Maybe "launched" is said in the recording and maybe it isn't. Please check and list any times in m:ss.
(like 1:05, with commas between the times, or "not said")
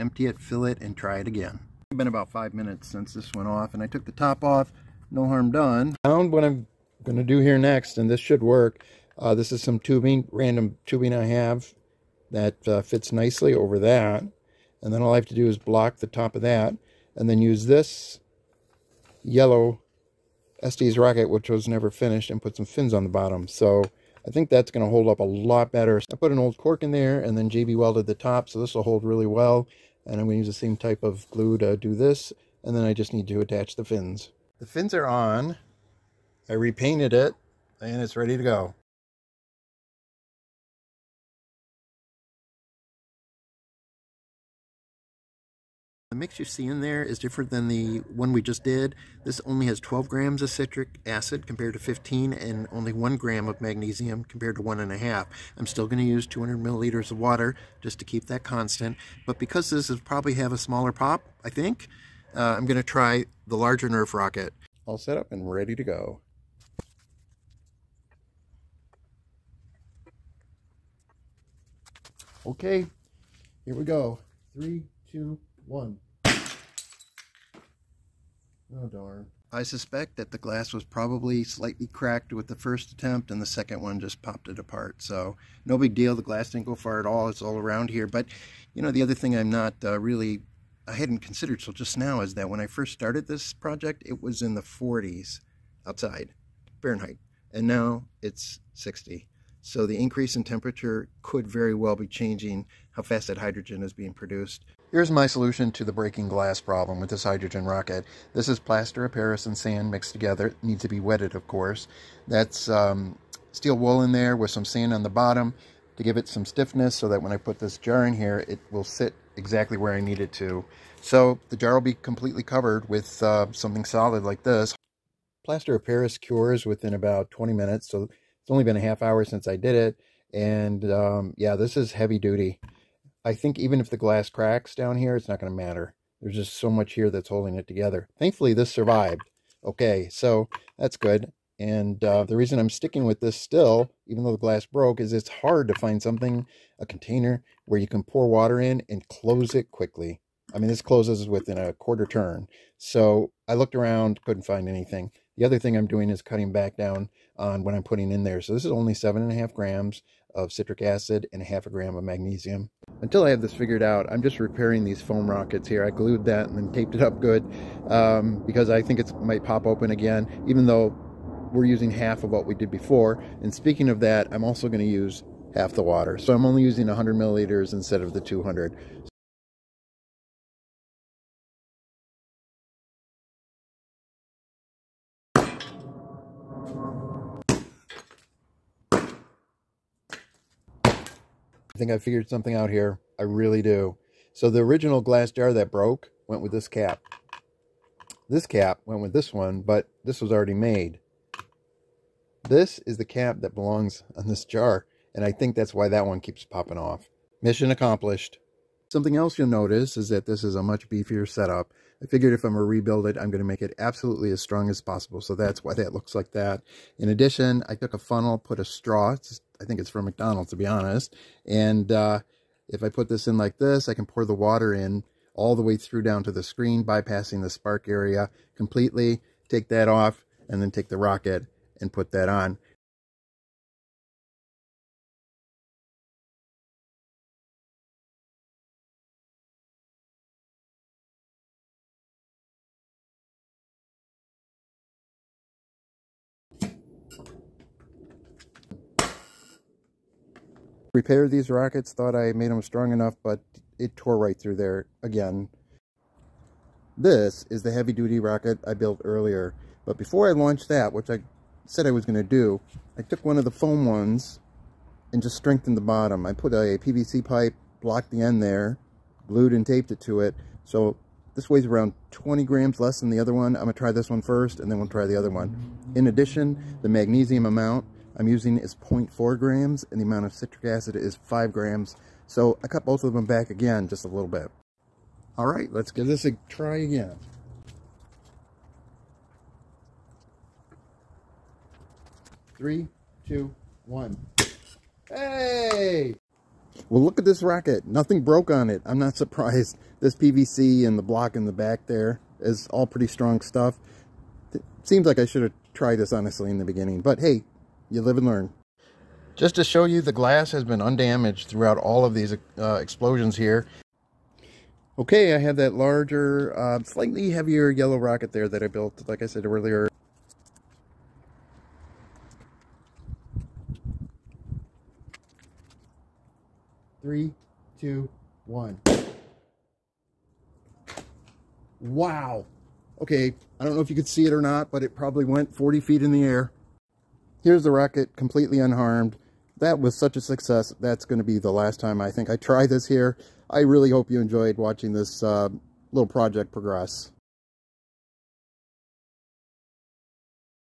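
4:20.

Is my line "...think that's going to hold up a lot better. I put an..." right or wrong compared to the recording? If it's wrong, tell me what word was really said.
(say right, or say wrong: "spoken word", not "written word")
right.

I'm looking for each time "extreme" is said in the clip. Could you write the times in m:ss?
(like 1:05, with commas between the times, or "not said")
not said.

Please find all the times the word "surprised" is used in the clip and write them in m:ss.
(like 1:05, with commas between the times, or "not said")
4:59.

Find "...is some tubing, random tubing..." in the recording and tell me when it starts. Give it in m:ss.
0:09.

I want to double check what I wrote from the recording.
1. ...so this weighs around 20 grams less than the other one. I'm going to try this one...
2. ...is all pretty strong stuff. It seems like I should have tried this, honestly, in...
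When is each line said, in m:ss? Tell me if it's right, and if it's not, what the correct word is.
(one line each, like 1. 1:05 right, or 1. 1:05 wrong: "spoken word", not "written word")
1. 4:30 right
2. 5:02 right.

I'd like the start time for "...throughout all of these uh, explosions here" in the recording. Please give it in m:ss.
5:11.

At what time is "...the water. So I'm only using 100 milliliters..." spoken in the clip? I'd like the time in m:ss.
2:55.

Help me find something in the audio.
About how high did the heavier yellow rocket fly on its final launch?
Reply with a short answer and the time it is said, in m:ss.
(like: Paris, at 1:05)
40 feet, at 5:35.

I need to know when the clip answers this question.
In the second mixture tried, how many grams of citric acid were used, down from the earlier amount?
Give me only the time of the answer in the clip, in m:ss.
0:49.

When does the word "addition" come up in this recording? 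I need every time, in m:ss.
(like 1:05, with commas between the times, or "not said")
3:37, 4:36.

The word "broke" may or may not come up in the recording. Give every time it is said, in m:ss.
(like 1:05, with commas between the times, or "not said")
2:24, 3:15, 4:58.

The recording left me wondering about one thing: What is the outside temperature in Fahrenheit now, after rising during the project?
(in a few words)
60.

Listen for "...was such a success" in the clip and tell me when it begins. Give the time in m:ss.
5:39.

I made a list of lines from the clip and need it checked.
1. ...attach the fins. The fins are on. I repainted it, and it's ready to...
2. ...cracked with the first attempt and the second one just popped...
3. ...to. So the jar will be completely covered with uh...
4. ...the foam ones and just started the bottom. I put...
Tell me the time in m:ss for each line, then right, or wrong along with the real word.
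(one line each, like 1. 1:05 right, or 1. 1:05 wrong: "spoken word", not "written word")
1. 0:33 right
2. 1:21 right
3. 2:00 right
4. 4:23 wrong: "strengthened", not "started".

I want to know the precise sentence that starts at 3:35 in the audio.
So that's why that looks like that.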